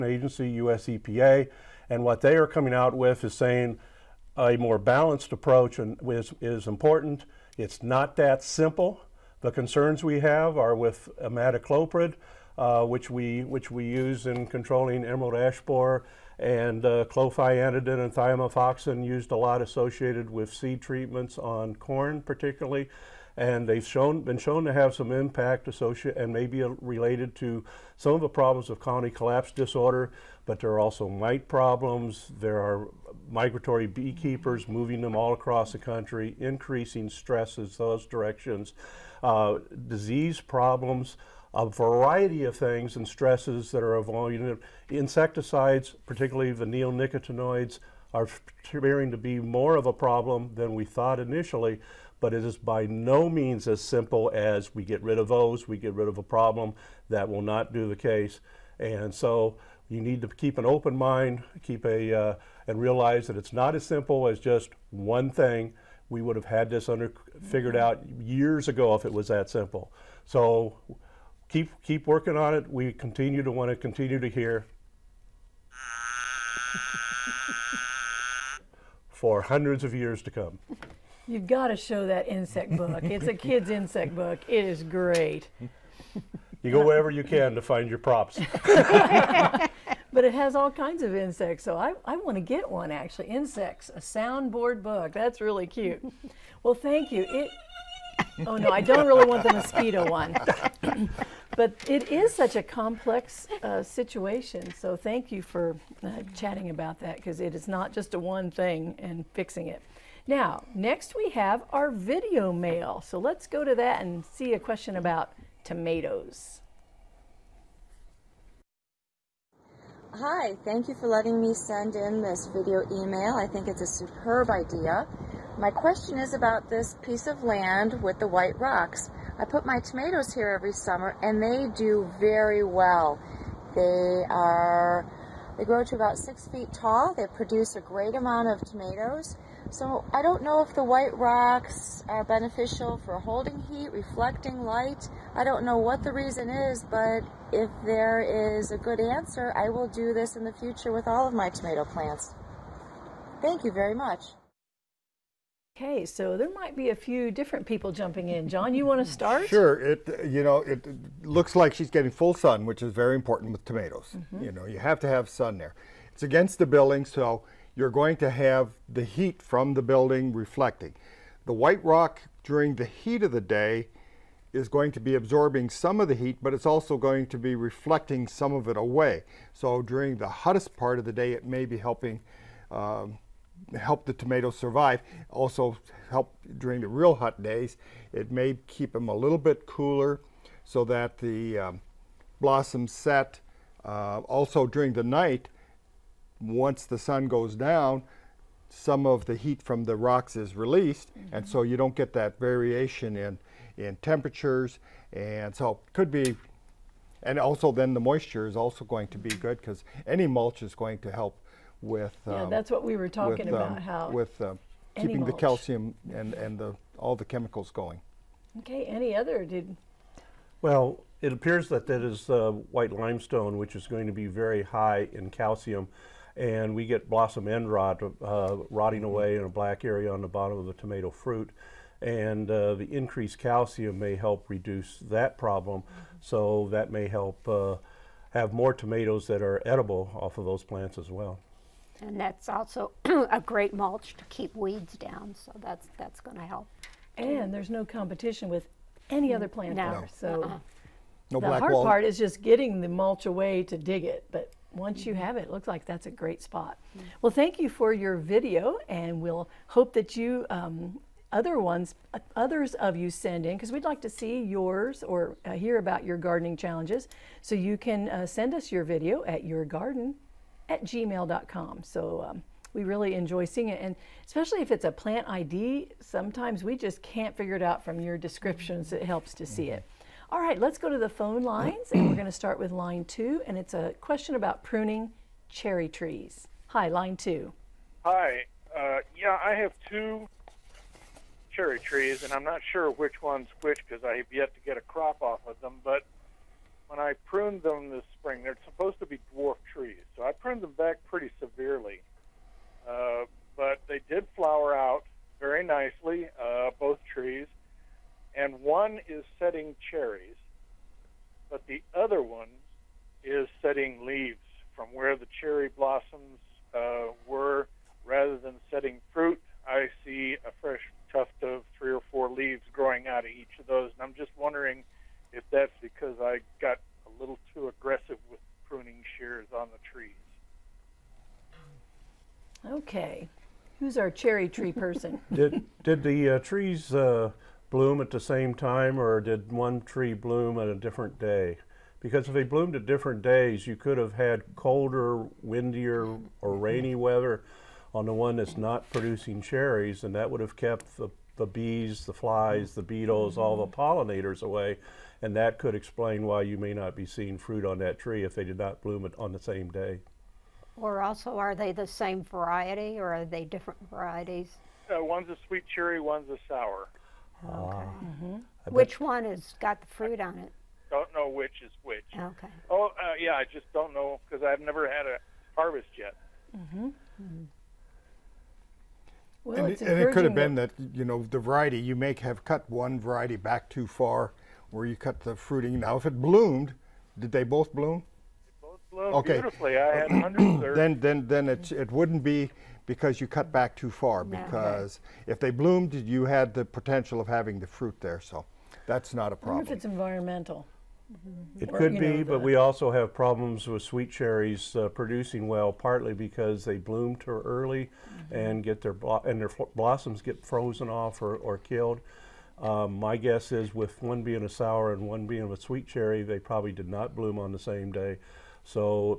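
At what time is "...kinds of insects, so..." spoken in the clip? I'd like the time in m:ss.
1:30.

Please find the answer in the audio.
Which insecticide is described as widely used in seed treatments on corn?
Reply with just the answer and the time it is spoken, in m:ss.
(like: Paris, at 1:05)
thiamethoxam, at 0:17.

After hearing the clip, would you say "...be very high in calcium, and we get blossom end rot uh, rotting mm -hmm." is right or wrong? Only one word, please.
right.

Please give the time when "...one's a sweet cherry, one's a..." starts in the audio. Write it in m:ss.
6:05.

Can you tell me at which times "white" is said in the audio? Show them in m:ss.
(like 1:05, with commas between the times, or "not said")
2:08, 2:20, 2:51, 3:42.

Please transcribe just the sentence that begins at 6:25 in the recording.
Now, if it bloomed, did they both bloom?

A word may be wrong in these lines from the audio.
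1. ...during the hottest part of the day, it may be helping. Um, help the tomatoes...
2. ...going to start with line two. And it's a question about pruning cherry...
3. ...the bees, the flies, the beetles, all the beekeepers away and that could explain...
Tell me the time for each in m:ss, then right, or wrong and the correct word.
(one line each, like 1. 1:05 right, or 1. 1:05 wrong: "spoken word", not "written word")
1. 2:59 right
2. 4:42 right
3. 5:51 wrong: "pollinators", not "beekeepers".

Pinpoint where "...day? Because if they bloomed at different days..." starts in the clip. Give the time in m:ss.
5:41.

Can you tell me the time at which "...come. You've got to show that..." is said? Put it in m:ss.
1:20.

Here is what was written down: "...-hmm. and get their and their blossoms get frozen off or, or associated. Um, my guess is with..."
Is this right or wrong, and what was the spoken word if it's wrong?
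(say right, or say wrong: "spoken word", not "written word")
wrong: "killed", not "associated".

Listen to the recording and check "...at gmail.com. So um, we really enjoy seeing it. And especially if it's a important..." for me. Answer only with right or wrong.
wrong.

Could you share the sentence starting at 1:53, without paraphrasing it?
So let's go to that and see a question about tomatoes.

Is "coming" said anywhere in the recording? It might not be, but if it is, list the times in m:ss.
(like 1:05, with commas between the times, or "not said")
0:02.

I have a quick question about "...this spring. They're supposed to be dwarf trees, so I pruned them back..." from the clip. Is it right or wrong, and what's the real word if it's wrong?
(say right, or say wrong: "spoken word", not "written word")
right.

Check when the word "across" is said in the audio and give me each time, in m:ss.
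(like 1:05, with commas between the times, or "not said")
0:35.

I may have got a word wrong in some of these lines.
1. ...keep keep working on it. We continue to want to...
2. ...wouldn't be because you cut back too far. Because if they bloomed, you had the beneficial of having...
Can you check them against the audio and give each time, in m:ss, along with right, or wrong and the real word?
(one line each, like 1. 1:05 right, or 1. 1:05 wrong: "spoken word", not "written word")
1. 1:11 right
2. 6:31 wrong: "potential", not "beneficial".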